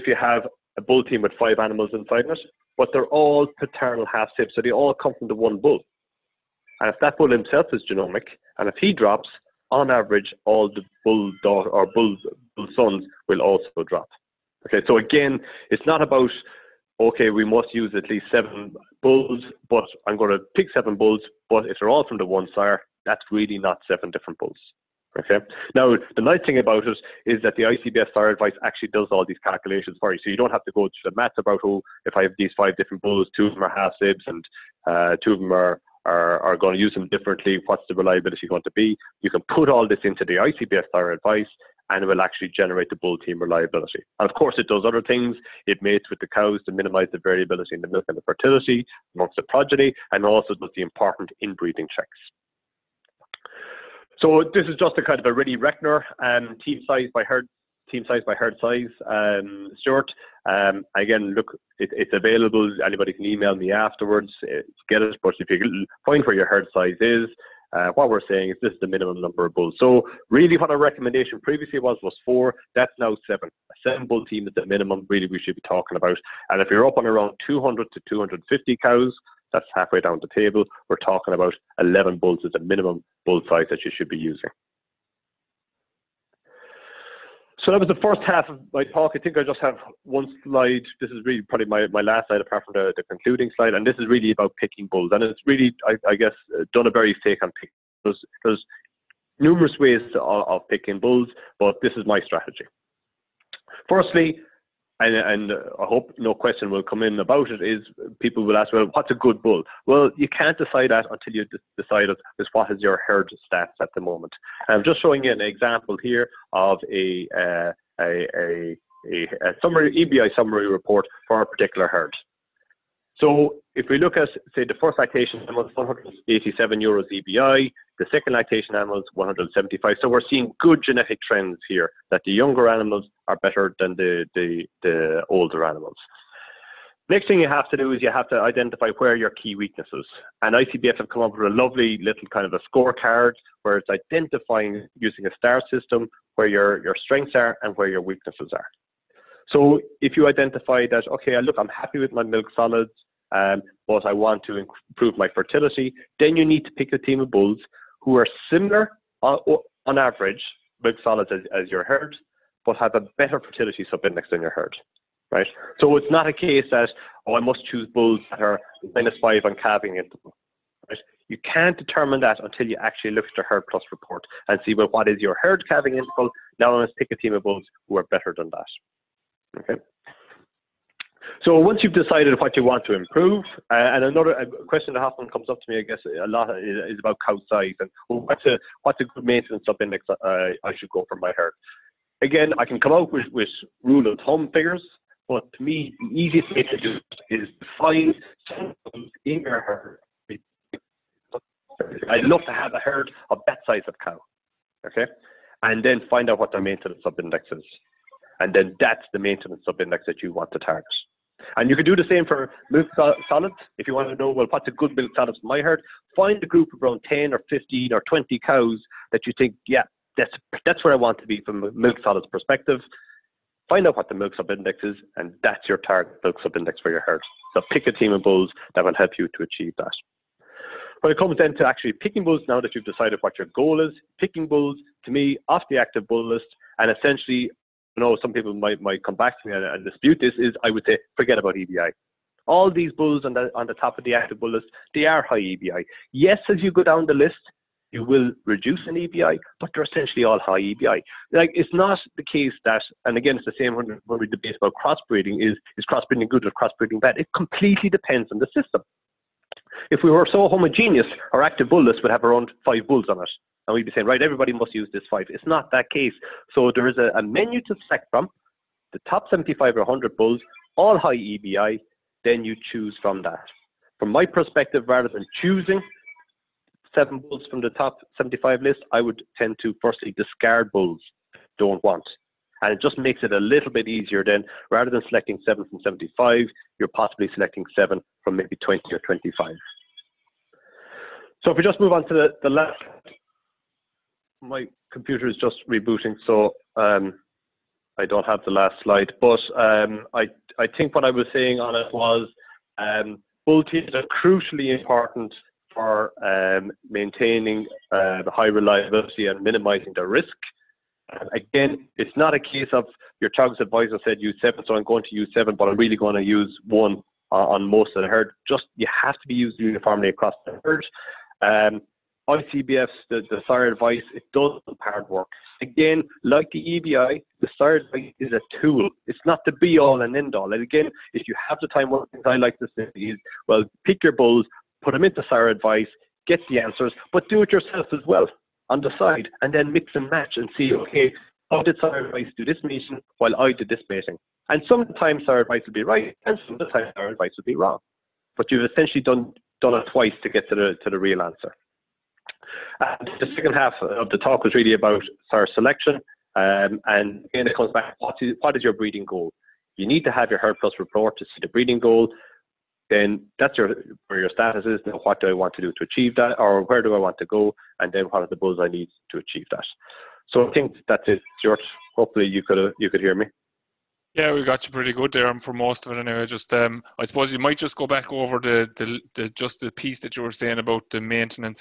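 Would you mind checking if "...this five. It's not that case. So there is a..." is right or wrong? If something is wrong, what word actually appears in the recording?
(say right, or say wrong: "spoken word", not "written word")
right.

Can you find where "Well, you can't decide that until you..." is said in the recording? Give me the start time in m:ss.
1:49.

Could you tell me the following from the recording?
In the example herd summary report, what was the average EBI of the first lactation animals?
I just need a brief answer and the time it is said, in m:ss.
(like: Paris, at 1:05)
187 euros, at 2:05.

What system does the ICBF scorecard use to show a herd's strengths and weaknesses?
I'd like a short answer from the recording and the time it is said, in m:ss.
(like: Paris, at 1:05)
Star system, at 2:25.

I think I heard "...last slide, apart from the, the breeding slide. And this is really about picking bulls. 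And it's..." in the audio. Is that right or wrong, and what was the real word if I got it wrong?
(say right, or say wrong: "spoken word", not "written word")
wrong: "concluding", not "breeding".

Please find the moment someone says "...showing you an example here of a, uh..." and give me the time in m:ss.
1:55.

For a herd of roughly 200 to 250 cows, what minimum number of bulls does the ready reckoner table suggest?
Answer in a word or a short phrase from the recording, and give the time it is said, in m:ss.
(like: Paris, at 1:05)
11, at 1:21.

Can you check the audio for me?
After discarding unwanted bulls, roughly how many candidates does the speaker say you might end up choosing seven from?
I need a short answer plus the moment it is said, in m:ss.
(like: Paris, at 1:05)
20 or 25, at 4:48.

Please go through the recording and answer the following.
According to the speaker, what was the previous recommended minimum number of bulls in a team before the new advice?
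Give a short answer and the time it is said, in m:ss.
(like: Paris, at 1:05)
4, at 1:12.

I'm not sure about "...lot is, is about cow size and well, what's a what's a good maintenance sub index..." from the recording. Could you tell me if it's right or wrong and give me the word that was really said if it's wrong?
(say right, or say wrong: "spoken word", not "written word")
right.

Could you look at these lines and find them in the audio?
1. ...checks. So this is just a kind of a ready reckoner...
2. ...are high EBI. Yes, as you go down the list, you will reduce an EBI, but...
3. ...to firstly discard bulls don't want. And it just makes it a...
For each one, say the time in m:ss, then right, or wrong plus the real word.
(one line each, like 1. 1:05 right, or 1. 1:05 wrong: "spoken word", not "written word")
1. 0:51 right
2. 4:05 right
3. 4:39 right.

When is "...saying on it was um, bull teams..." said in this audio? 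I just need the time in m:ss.
5:01.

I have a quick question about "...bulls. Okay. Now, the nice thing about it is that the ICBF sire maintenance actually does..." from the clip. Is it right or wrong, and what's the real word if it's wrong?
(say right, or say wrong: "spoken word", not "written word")
wrong: "advice", not "maintenance".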